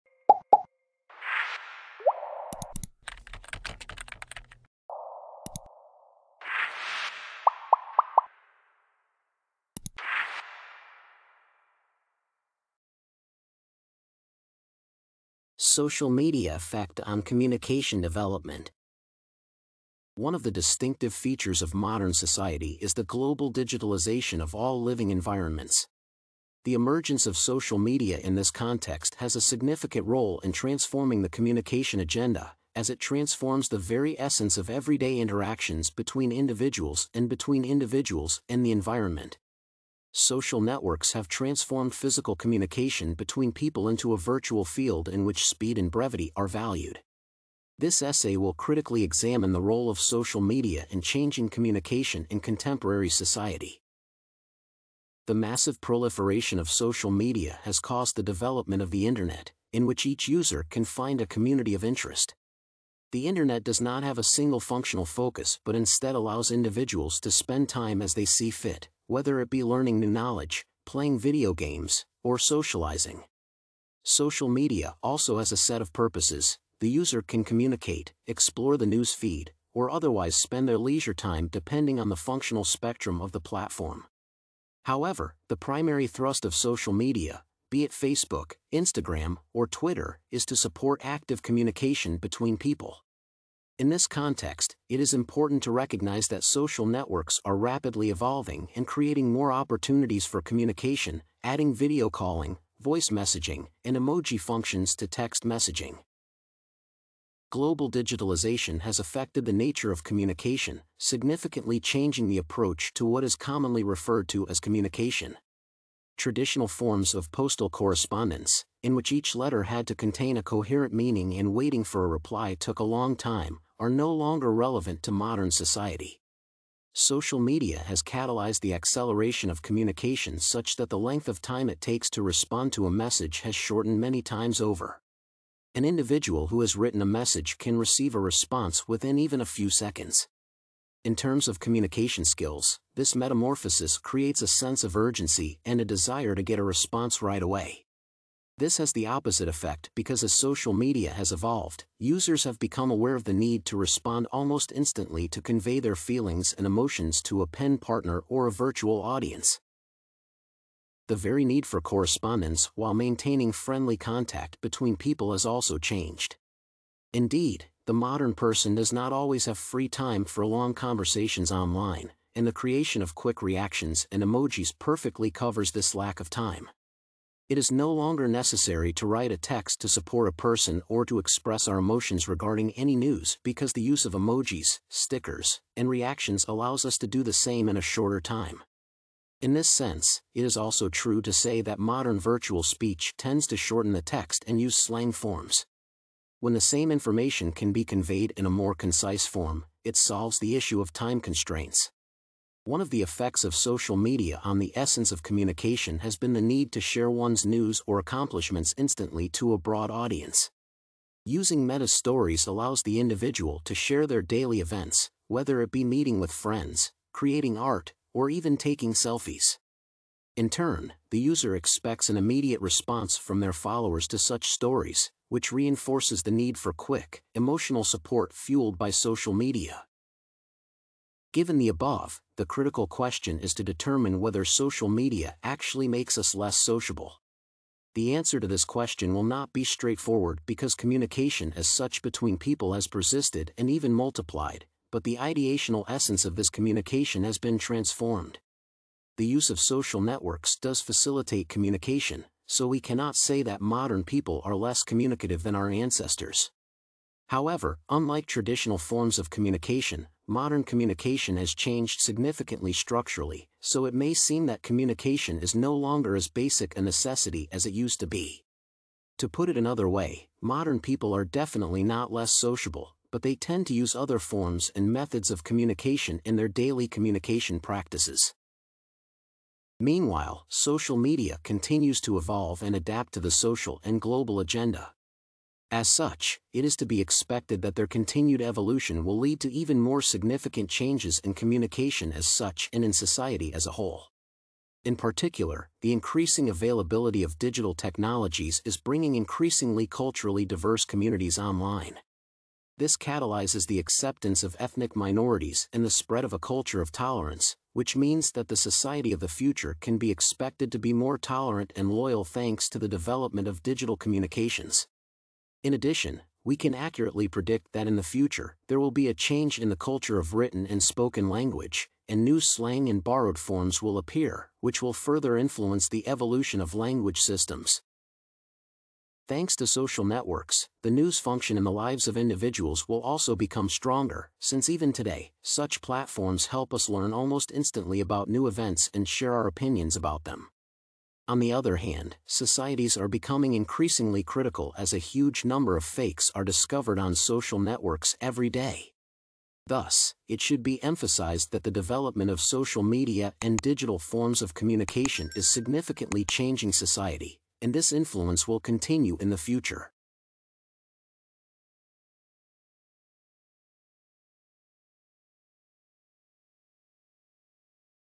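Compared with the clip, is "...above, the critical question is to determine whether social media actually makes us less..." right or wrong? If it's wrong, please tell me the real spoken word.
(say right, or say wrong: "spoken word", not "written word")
right.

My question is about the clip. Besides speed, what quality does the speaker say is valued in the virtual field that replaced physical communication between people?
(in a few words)
brevity.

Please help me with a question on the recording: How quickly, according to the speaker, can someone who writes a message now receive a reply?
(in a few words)
a few seconds.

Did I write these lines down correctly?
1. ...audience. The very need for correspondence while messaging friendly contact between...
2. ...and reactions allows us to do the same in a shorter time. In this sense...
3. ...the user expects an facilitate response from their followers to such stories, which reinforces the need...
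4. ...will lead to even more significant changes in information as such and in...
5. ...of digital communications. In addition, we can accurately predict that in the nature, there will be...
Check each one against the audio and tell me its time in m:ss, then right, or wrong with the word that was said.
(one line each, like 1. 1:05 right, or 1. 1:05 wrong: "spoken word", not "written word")
1. 2:39 wrong: "maintaining", not "messaging"
2. 3:05 right
3. 3:41 wrong: "immediate", not "facilitate"
4. 4:49 wrong: "communication", not "information"
5. 5:13 wrong: "future", not "nature".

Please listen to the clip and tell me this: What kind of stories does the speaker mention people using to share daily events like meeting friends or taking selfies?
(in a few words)
meta stories.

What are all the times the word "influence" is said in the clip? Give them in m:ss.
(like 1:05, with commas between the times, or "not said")
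5:25, 5:57.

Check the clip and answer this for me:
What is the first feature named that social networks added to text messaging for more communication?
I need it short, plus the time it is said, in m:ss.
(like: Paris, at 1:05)
video calling, at 1:41.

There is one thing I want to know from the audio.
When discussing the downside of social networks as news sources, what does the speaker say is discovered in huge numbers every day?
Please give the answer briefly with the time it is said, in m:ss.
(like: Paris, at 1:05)
fakes, at 5:45.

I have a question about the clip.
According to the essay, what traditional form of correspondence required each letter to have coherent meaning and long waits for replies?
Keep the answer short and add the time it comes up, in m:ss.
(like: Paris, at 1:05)
postal correspondence, at 1:57.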